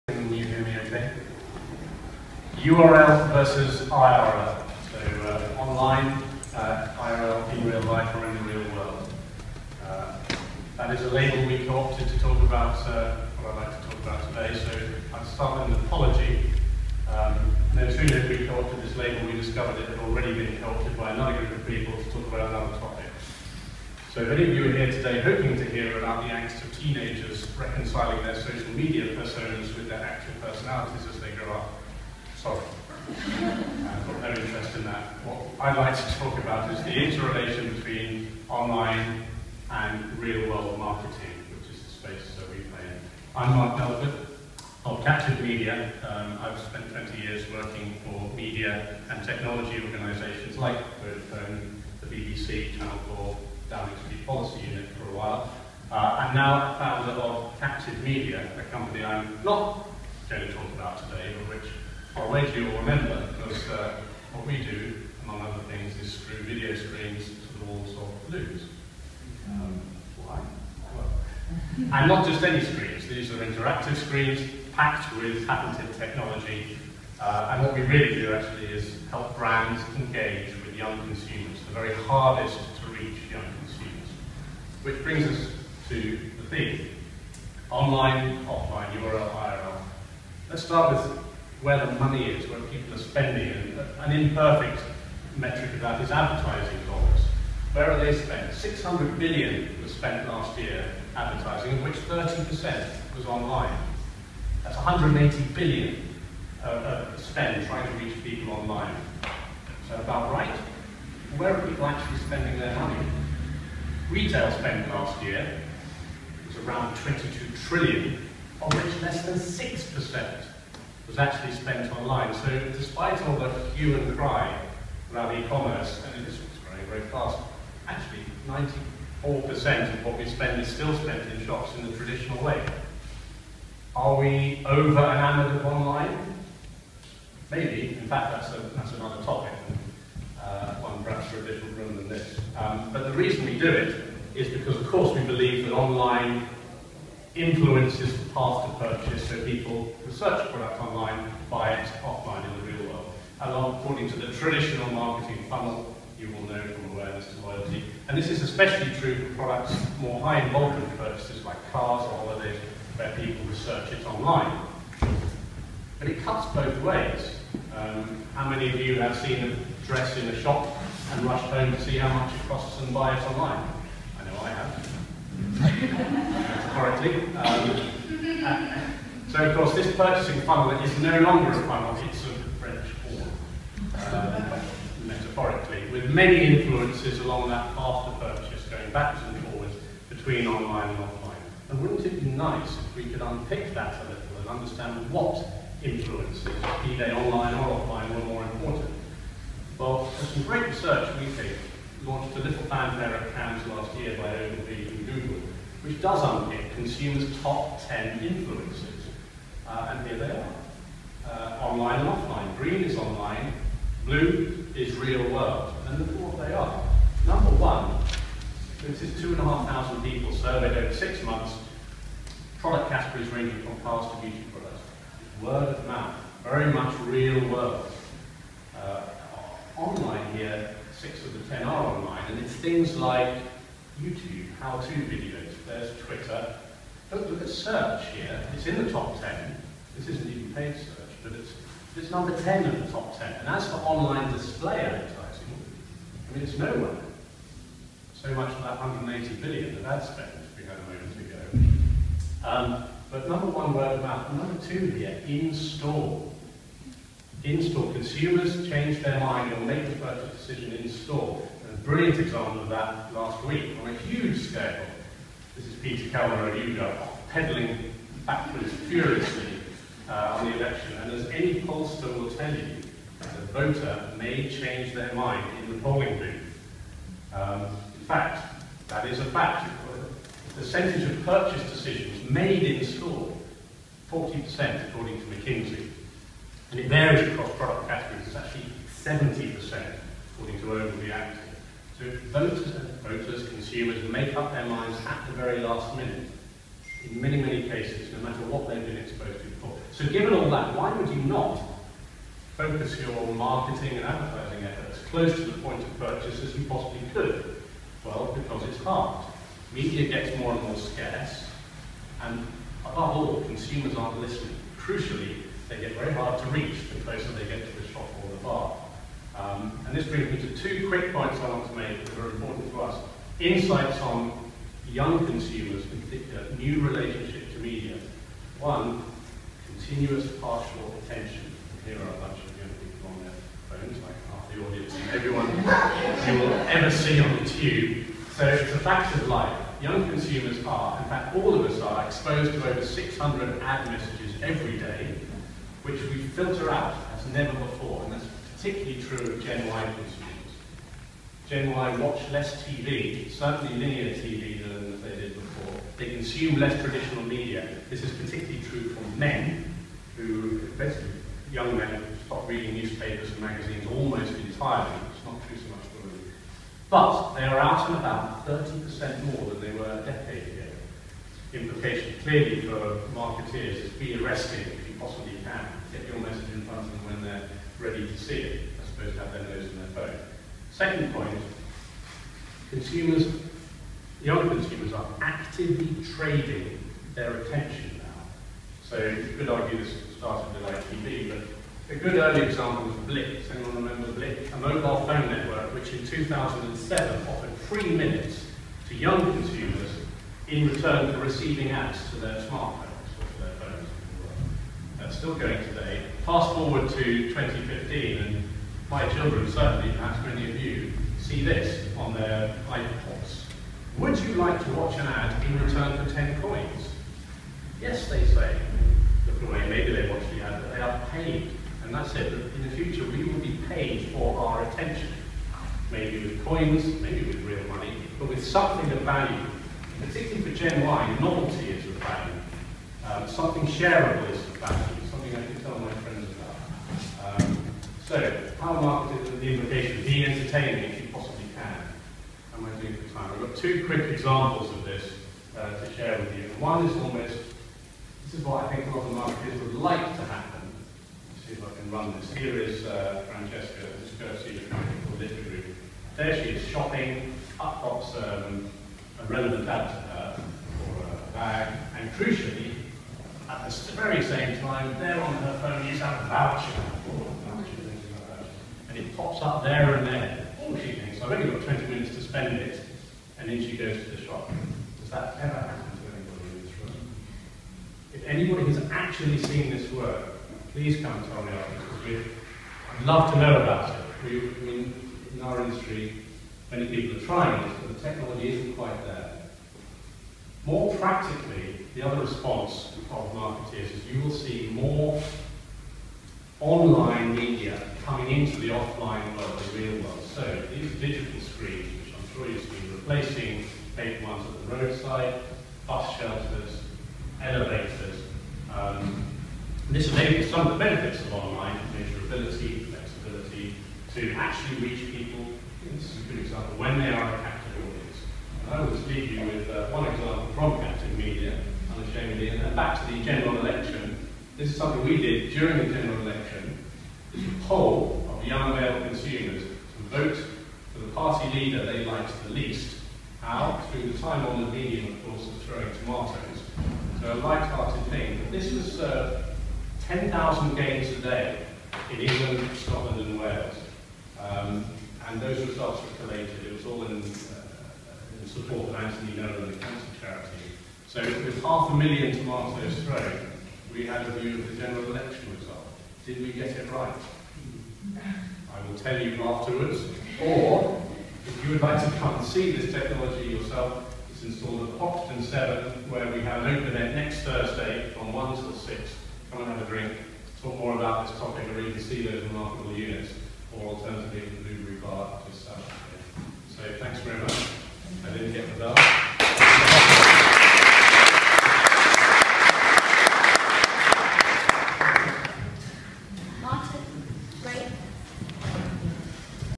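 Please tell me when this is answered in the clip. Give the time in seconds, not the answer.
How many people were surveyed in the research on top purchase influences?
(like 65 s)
219 s.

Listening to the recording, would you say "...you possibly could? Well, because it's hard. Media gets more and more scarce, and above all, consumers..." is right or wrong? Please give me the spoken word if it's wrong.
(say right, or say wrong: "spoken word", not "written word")
right.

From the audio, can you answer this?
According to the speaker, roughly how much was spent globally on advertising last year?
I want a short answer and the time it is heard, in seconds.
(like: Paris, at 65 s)
600 billion, at 98 s.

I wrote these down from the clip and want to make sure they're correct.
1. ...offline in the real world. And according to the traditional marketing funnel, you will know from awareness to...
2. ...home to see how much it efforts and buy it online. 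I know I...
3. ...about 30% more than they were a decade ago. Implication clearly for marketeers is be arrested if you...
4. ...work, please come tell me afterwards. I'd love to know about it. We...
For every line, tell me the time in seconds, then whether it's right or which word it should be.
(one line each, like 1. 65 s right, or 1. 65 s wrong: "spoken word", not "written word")
1. 152 s right
2. 171 s wrong: "costs", not "efforts"
3. 367 s right
4. 479 s right.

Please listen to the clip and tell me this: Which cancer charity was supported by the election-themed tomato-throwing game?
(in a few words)
Anthony Nolan.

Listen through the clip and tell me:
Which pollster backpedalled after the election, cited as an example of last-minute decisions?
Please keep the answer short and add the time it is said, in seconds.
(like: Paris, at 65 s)
Peter Kellner, at 265 s.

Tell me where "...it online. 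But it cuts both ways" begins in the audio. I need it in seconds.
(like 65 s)
163 s.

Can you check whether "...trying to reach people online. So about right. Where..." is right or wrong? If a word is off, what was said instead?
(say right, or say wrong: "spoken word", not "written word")
right.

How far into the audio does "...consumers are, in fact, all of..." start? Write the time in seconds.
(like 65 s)
340 s.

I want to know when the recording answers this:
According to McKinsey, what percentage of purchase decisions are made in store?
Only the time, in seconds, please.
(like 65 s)
284 s.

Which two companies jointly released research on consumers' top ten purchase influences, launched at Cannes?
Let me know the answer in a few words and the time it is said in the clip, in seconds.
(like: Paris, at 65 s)
Ogilvy and Google, at 204 s.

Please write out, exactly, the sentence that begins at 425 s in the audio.
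Maybe with coins, maybe with real money, but with something of value.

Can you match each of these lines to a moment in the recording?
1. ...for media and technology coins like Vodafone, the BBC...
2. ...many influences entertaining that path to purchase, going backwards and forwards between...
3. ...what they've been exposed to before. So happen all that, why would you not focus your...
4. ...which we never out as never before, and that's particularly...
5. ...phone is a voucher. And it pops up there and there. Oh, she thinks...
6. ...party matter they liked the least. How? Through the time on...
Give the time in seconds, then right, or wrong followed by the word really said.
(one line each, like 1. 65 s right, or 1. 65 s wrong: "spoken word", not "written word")
1. 48 s wrong: "organisations", not "coins"
2. 186 s wrong: "along", not "entertaining"
3. 298 s wrong: "given", not "happen"
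4. 345 s wrong: "filter", not "never"
5. 465 s right
6. 531 s wrong: "leader", not "matter".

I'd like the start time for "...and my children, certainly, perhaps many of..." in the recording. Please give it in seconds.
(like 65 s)
408 s.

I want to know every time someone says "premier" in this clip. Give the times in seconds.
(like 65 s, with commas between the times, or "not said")
not said.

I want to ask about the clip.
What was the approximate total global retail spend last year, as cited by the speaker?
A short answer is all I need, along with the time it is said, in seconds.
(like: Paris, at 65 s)
22 trillion, at 116 s.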